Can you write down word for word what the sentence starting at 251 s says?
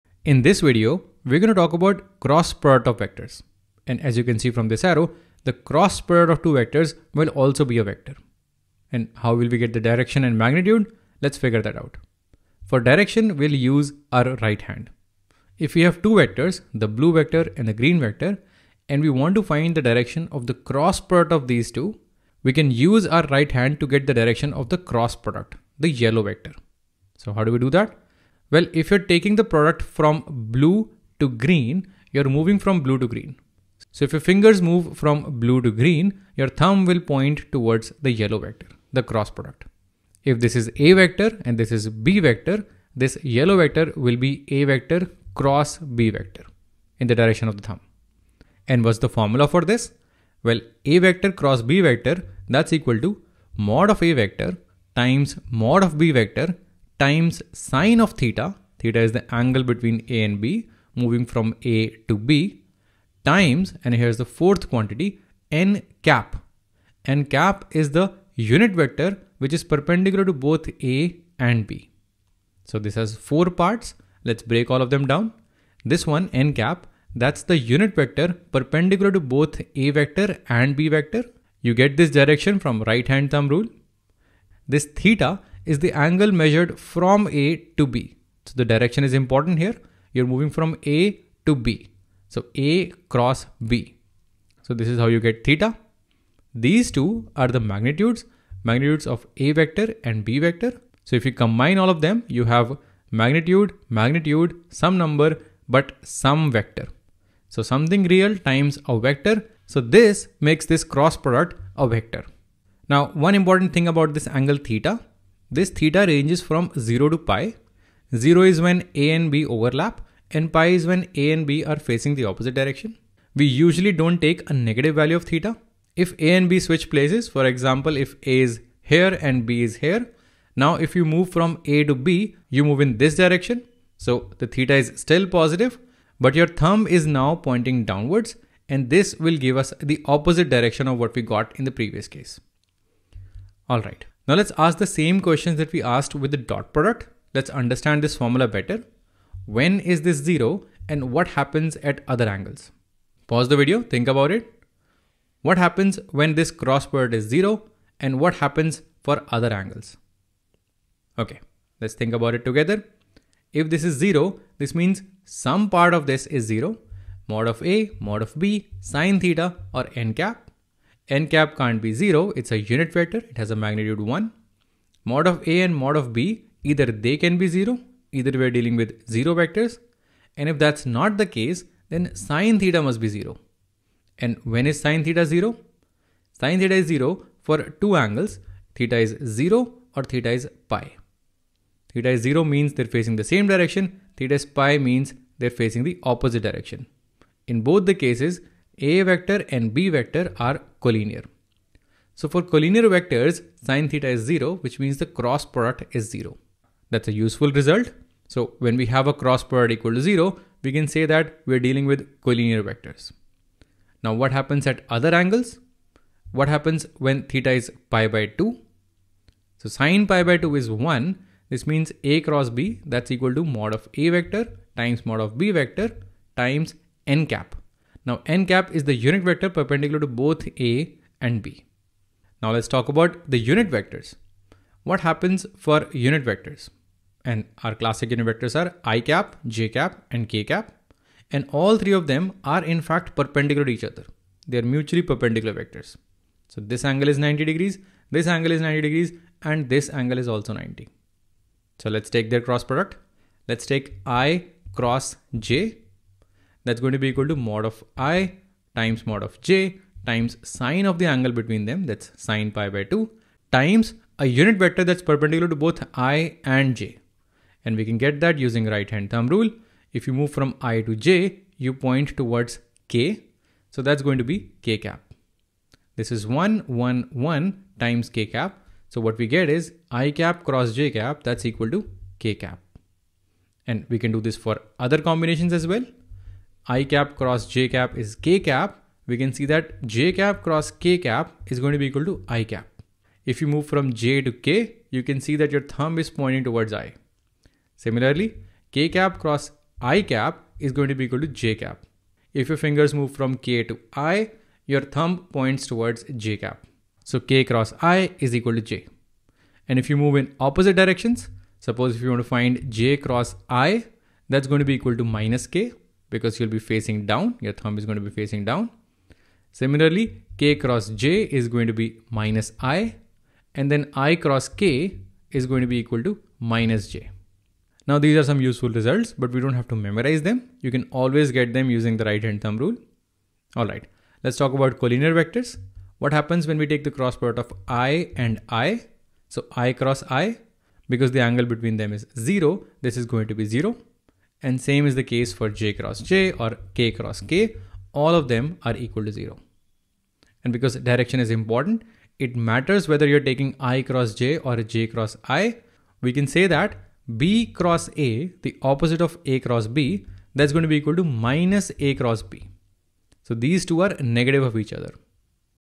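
So let's take their cross product.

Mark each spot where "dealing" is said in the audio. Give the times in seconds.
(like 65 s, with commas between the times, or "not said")
178 s, 211 s.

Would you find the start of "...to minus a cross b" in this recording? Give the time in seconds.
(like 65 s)
360 s.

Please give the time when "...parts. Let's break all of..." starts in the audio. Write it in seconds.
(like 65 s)
73 s.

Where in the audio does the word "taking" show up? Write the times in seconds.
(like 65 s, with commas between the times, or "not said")
28 s, 353 s.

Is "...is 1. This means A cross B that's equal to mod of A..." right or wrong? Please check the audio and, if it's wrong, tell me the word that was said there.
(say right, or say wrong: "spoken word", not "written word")
right.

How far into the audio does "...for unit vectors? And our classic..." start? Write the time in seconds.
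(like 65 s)
235 s.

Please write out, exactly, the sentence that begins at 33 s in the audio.
So if your fingers move from blue to green, your thumb will point towards the yellow vector, the cross product.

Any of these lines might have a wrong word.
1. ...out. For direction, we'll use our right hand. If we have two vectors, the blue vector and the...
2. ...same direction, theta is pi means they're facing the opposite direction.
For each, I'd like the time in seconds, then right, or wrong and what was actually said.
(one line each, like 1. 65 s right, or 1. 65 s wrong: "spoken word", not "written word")
1. 11 s right
2. 193 s right.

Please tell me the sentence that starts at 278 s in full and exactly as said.
So what we get is i cap cross j cap, that's equal to k cap.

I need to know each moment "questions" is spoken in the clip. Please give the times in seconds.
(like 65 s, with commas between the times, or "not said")
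145 s.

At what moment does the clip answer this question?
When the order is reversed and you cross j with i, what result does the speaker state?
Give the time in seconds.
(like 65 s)
315 s.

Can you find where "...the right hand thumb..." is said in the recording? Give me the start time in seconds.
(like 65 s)
331 s.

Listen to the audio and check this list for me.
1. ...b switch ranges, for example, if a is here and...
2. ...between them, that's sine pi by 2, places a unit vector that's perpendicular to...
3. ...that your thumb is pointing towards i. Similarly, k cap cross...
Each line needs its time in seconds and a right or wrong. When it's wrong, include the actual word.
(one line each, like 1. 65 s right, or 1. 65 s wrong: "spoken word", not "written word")
1. 126 s wrong: "places", not "ranges"
2. 261 s wrong: "times", not "places"
3. 295 s right.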